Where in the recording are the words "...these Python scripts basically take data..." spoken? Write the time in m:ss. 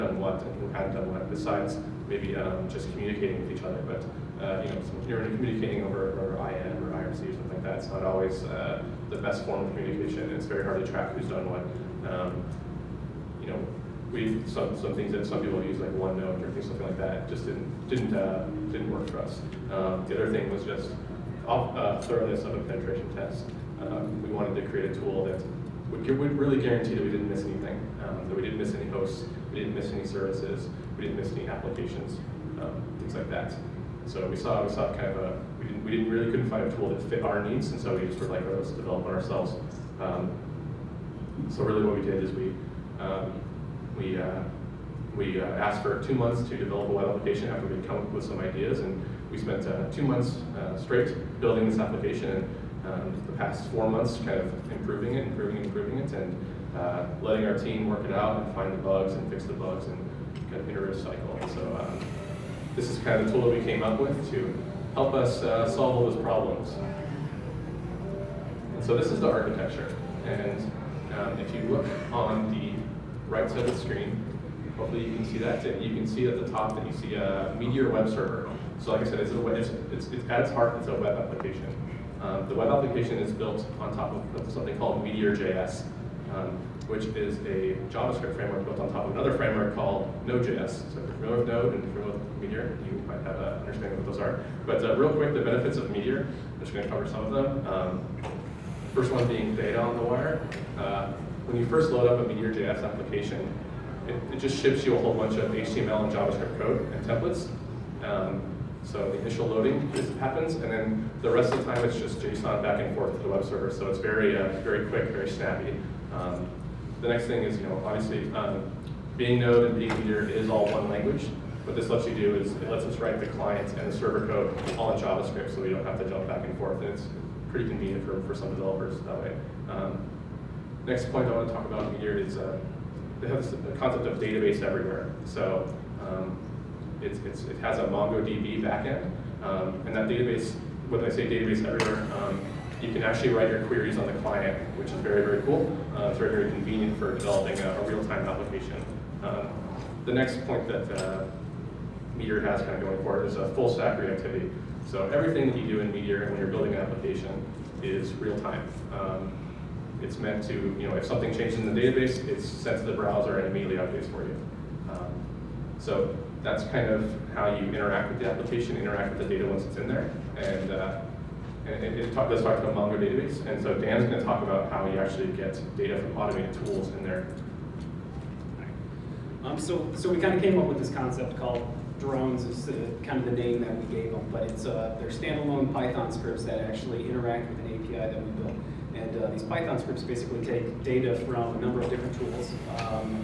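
3:09.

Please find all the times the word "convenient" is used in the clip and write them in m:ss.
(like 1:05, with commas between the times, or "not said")
2:07, 2:26.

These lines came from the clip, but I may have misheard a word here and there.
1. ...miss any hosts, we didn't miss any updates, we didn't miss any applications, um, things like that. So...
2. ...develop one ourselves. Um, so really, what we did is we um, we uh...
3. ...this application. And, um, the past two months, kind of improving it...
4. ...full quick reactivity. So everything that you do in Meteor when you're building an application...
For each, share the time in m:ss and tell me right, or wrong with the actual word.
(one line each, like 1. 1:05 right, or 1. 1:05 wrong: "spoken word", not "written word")
1. 0:28 wrong: "services", not "updates"
2. 0:38 right
3. 0:51 wrong: "four", not "two"
4. 2:33 wrong: "stack", not "quick".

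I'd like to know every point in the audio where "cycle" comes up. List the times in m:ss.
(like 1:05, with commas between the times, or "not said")
1:01.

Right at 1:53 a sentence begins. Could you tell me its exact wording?
So it's very, uh, very quick, very snappy.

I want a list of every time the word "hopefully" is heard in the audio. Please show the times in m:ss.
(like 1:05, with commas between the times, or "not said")
1:14.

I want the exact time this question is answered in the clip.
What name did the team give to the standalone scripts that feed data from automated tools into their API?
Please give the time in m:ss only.
3:02.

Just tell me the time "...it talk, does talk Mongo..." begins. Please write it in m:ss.
2:51.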